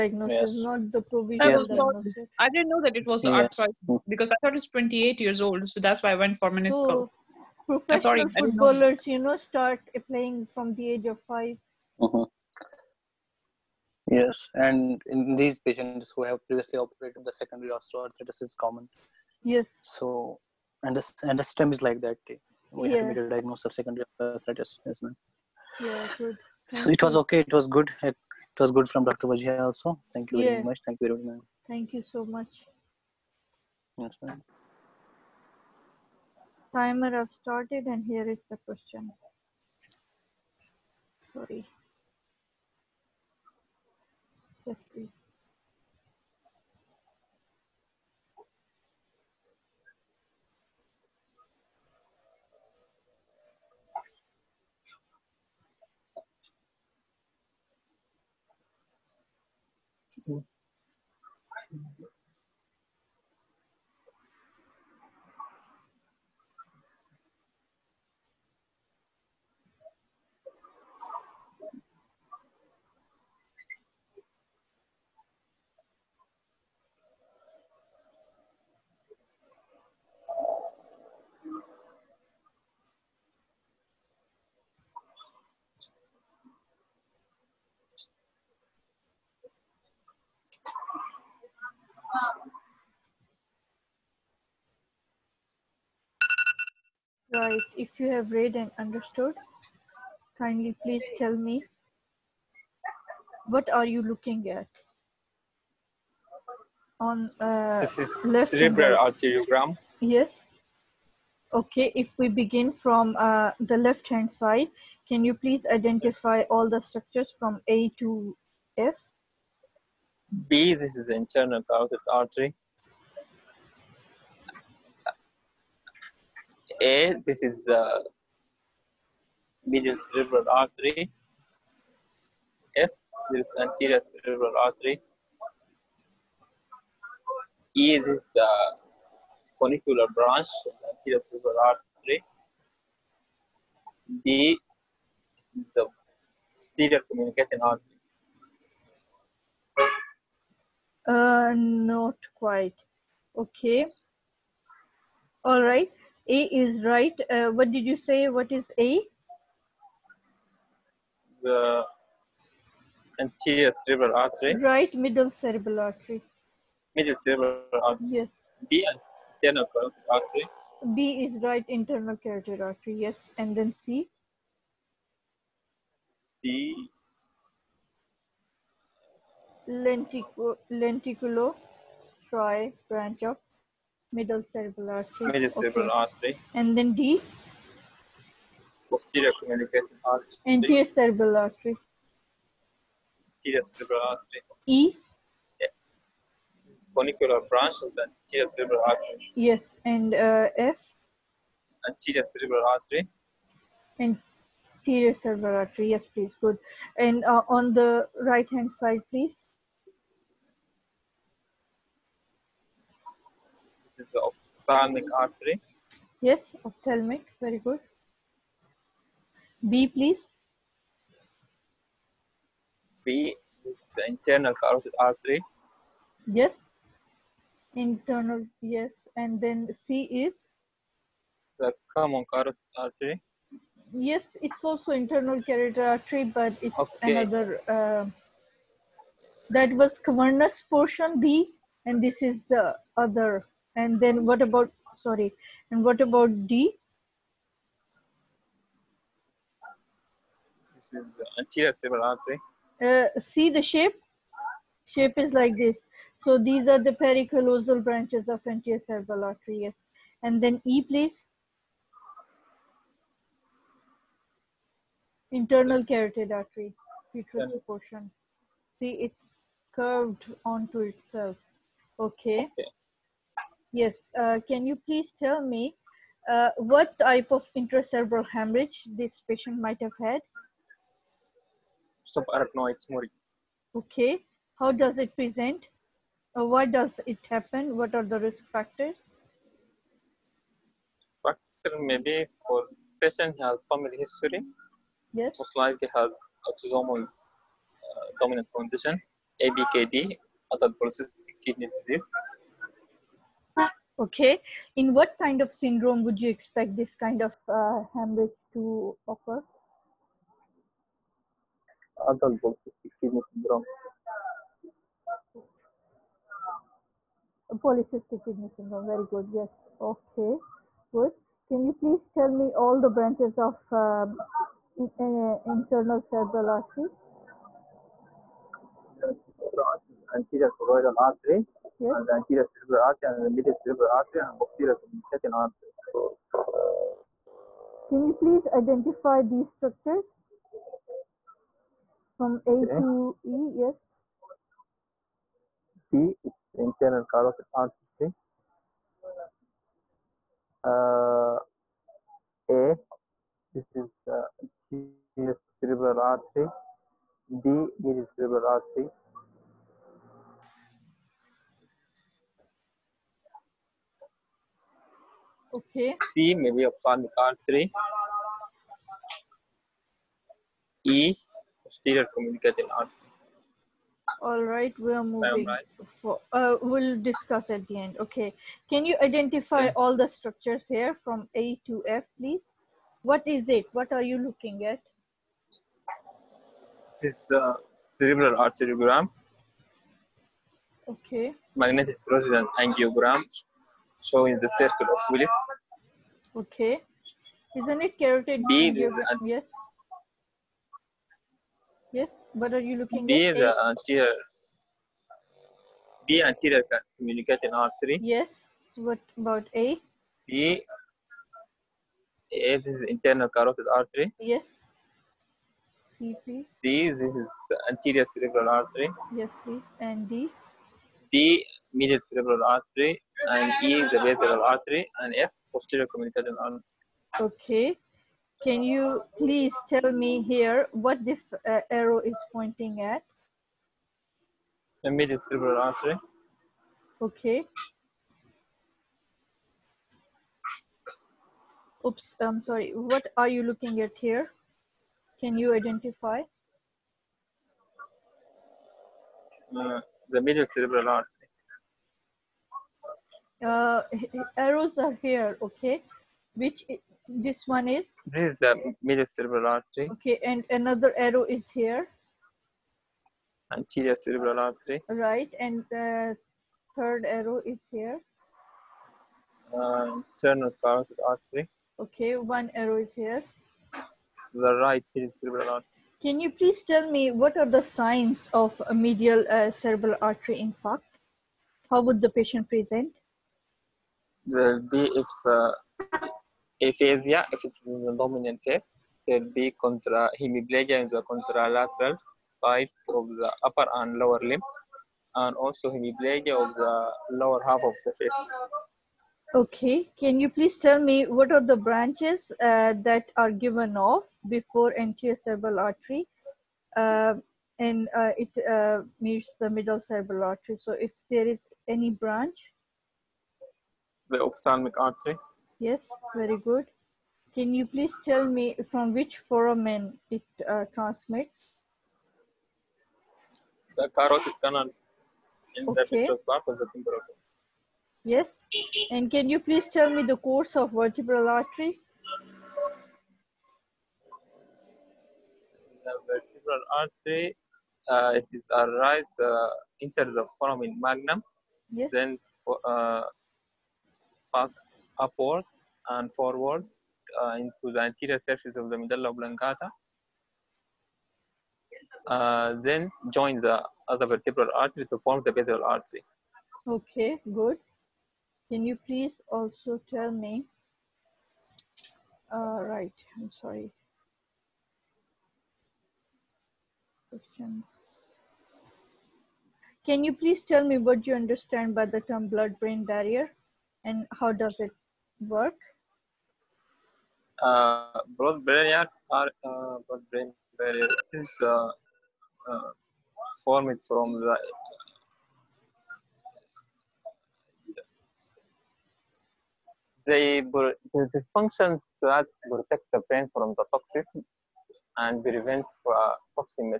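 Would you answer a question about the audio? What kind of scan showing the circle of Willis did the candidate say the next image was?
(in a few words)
Magnetic resonance angiogram.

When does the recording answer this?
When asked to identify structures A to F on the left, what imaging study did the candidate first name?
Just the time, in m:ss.
1:48.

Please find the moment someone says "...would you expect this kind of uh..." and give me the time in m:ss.
5:06.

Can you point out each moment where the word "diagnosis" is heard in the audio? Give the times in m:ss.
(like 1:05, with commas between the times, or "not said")
0:01, 0:23.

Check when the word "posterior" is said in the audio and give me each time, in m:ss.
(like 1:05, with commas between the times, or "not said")
2:26, 3:08, 5:34, 6:11, 7:05.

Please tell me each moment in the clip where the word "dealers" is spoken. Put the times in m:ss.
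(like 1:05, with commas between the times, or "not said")
not said.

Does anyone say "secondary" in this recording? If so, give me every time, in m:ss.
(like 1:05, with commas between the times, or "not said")
0:17, 0:23.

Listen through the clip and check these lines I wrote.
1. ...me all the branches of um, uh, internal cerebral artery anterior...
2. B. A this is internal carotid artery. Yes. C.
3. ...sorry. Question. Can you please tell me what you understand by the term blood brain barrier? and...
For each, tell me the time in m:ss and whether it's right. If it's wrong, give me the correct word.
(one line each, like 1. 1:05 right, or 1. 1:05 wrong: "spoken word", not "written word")
1. 5:22 right
2. 6:50 right
3. 9:23 right.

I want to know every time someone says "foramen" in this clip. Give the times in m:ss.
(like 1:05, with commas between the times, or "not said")
8:39, 9:00.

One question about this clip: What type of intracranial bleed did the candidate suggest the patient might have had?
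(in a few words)
Subarachnoid hemorrhage.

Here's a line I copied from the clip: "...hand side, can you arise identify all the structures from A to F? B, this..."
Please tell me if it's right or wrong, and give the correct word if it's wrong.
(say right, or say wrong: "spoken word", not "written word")
wrong: "please", not "arise".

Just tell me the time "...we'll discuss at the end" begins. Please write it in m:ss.
6:16.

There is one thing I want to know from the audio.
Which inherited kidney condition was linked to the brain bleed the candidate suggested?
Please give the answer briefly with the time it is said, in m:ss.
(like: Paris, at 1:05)
Adult polycystic kidney disease, at 5:00.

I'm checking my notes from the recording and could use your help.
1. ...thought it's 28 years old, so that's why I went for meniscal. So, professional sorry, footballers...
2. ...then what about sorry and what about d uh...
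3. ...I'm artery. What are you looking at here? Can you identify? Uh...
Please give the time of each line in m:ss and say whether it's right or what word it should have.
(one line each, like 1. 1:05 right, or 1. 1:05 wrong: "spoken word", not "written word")
1. 0:04 right
2. 4:03 right
3. 7:22 wrong: "sorry", not "artery".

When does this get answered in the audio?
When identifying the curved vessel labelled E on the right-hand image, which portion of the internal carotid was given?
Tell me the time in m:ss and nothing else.
4:27.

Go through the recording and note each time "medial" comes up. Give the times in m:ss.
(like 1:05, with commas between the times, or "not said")
2:09, 7:01, 7:14, 7:30, 7:58.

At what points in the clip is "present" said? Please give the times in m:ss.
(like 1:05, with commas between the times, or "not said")
4:45, 8:02.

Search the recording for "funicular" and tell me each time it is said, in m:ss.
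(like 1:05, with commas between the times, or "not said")
2:19, 3:16.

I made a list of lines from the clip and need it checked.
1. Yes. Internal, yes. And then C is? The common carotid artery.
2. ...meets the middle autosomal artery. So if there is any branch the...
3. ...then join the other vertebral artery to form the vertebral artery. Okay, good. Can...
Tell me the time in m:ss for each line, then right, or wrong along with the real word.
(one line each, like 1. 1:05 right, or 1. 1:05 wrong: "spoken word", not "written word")
1. 3:46 right
2. 8:28 wrong: "cerebral", not "autosomal"
3. 9:12 right.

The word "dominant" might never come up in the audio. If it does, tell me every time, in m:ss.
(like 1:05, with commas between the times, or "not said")
4:58, 8:07.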